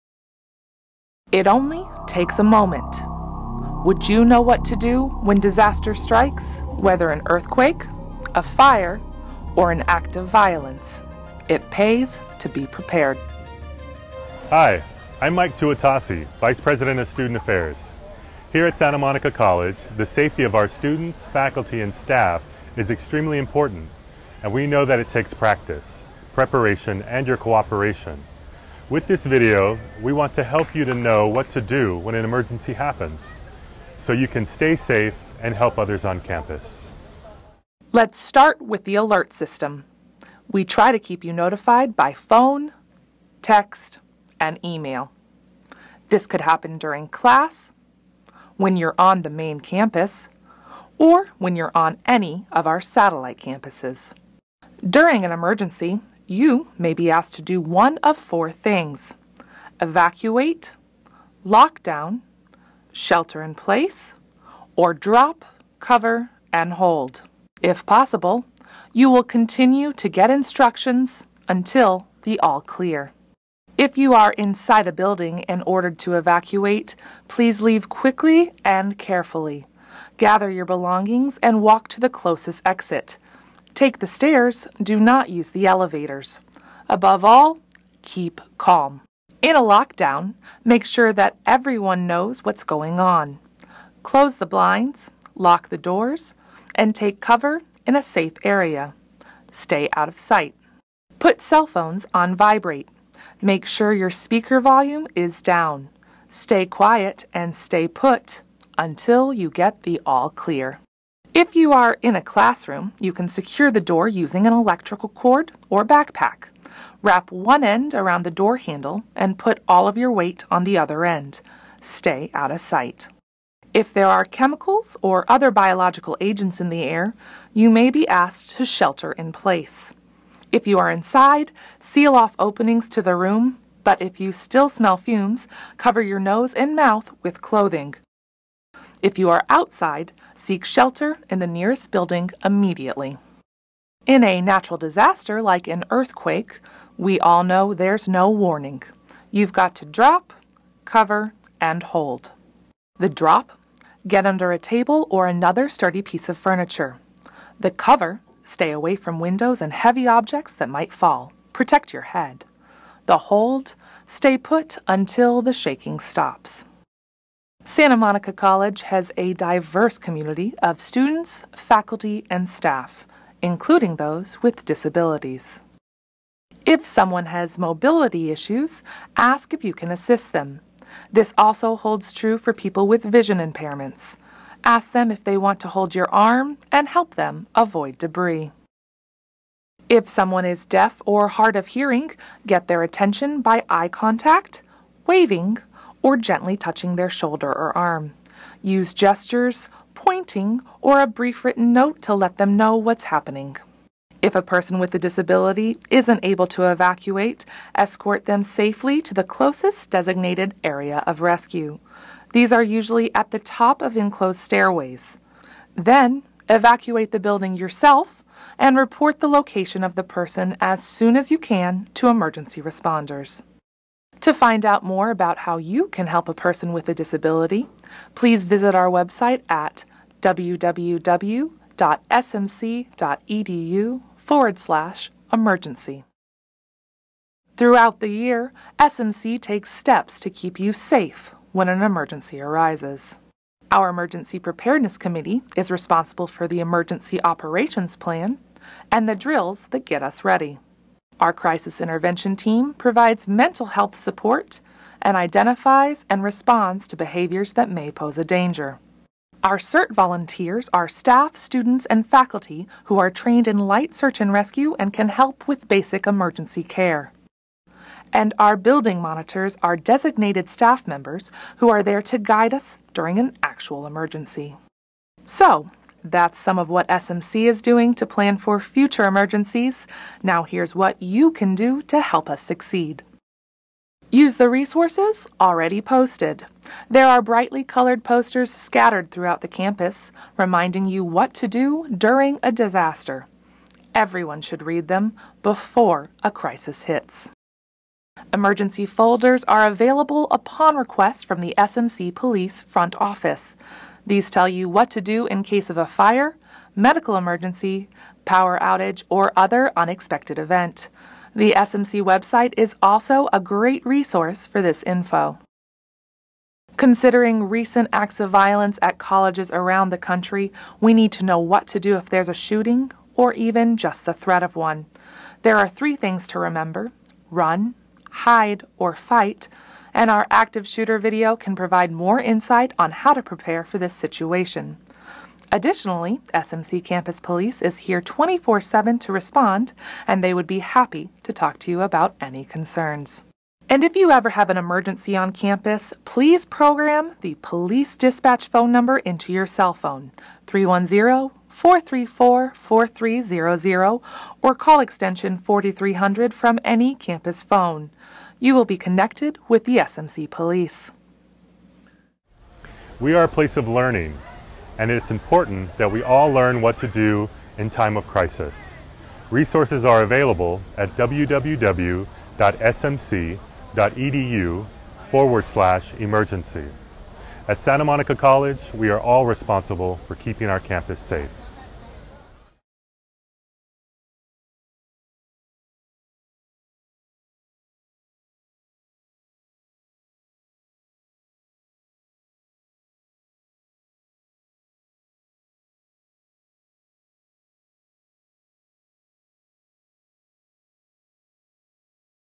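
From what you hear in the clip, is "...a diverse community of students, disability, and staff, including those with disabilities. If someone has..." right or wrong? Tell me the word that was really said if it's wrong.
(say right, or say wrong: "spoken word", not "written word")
wrong: "faculty", not "disability".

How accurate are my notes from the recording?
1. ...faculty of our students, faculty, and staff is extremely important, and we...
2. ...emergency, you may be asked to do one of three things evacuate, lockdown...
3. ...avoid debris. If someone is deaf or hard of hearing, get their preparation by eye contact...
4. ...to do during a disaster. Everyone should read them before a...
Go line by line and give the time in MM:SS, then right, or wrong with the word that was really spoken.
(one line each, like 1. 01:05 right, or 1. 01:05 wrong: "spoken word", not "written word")
1. 00:20 wrong: "safety", not "faculty"
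2. 00:55 wrong: "four", not "three"
3. 03:07 wrong: "attention", not "preparation"
4. 04:51 right.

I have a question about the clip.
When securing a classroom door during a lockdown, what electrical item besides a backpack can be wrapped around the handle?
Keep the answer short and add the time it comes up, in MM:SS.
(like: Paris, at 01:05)
electrical cord, at 01:54.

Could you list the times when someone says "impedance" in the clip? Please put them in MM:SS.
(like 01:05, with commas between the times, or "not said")
not said.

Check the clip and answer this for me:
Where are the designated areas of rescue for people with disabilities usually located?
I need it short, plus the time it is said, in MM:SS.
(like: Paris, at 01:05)
top of enclosed stairways, at 03:33.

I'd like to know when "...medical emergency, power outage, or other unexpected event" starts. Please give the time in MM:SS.
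05:06.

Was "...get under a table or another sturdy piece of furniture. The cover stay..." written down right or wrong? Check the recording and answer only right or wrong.
right.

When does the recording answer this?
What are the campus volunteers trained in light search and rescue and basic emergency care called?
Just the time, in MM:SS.
04:19.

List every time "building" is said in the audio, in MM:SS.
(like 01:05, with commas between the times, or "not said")
01:14, 02:21, 03:37, 04:28.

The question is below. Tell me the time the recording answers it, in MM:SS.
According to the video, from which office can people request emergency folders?
05:01.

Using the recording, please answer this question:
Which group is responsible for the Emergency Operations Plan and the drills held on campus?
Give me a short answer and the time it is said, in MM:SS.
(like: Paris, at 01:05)
Emergency Preparedness Committee, at 04:03.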